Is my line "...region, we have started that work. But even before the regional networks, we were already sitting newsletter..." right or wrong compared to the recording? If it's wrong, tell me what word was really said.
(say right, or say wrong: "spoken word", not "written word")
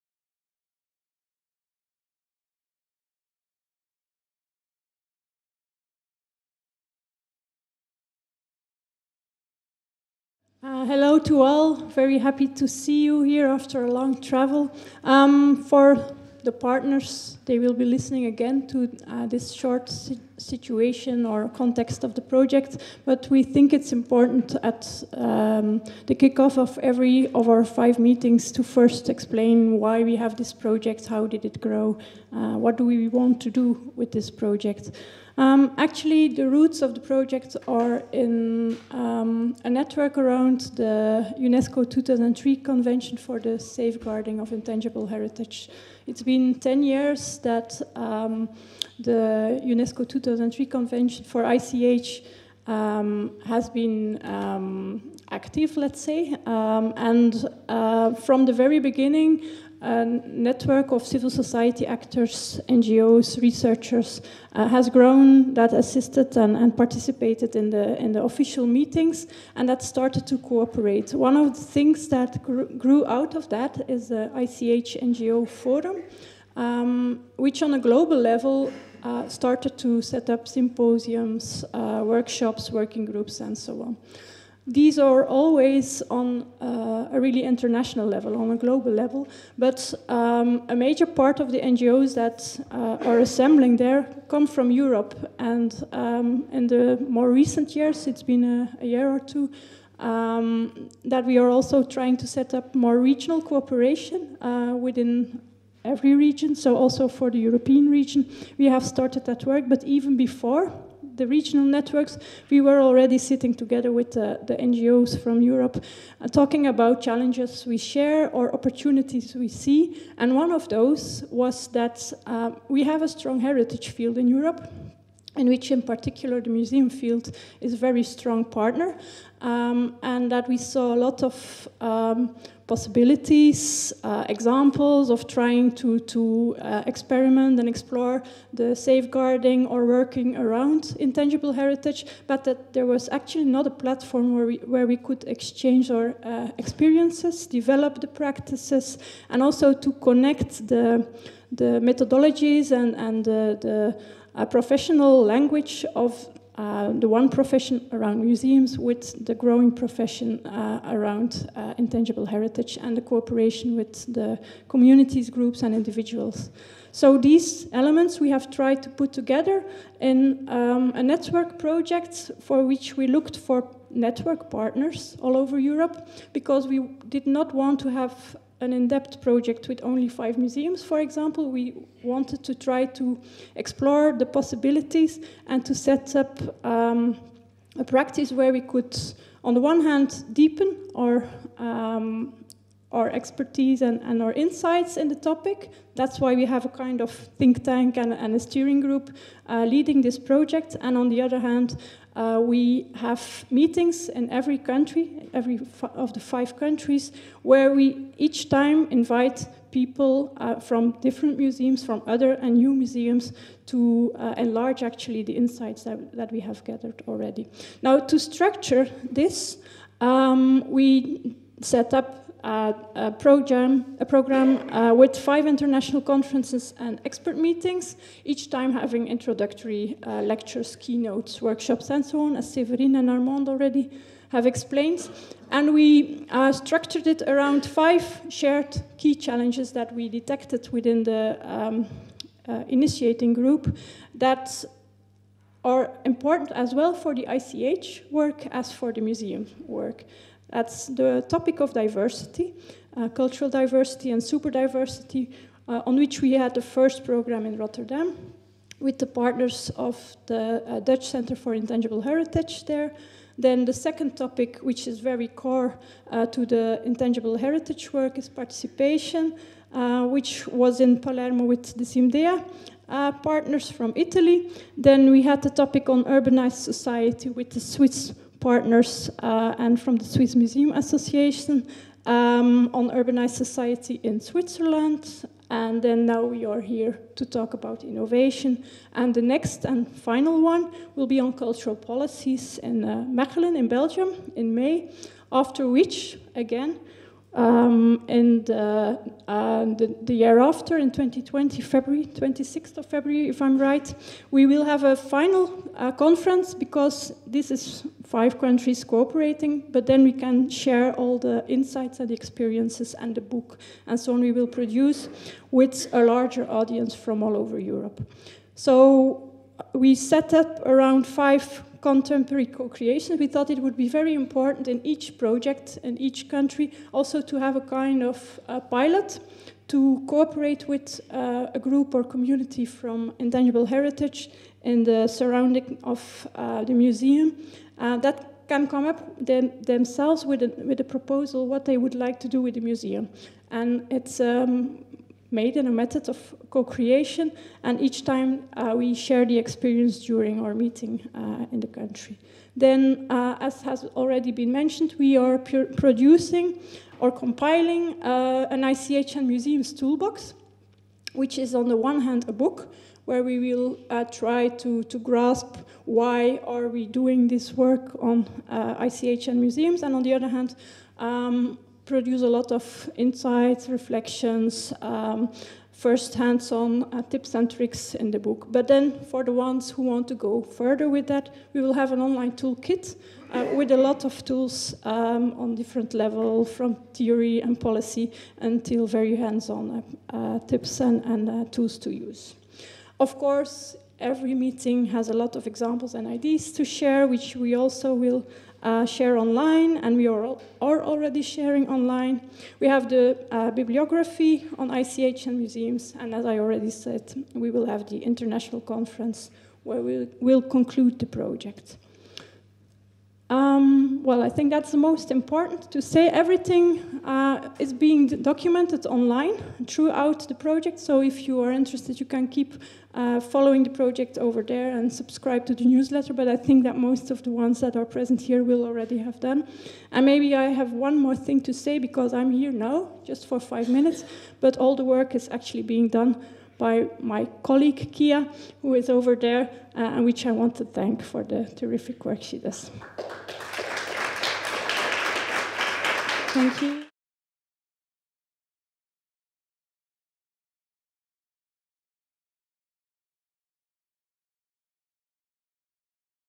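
wrong: "together", not "newsletter".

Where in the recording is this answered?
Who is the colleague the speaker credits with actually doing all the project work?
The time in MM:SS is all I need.
07:17.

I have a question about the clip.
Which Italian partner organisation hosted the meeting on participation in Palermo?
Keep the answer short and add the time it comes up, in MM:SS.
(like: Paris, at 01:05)
SIMBDEA, at 04:31.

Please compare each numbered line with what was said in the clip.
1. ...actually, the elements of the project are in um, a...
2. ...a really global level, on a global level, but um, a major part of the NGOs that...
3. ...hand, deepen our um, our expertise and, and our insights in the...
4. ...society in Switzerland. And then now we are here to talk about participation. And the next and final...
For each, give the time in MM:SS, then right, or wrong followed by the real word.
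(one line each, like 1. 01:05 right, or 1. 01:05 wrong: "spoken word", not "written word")
1. 00:35 wrong: "roots", not "elements"
2. 01:27 wrong: "international", not "global"
3. 03:09 right
4. 04:43 wrong: "innovation", not "participation".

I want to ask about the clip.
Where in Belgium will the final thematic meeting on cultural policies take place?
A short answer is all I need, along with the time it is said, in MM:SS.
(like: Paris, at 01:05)
Mechelen, at 04:53.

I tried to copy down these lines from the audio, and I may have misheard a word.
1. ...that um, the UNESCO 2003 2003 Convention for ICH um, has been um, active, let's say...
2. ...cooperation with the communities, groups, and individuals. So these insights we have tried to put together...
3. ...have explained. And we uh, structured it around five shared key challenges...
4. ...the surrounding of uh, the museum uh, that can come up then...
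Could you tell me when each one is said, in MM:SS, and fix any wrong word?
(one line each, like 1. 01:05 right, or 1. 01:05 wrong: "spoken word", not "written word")
1. 00:47 right
2. 02:43 wrong: "elements", not "insights"
3. 03:54 right
4. 05:34 right.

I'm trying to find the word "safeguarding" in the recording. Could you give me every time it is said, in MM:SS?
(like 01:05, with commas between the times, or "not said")
00:43, 02:18.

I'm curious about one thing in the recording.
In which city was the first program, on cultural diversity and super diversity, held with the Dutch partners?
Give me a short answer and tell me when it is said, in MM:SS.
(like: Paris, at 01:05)
Rotterdam, at 04:17.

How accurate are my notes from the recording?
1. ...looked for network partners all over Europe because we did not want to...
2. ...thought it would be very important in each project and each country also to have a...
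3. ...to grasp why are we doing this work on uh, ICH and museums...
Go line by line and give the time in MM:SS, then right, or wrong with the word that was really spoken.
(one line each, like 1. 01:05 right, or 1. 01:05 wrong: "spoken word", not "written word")
1. 02:53 right
2. 05:23 right
3. 06:04 right.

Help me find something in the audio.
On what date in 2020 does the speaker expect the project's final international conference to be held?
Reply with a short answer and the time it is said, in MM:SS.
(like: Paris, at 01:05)
26 February, at 05:02.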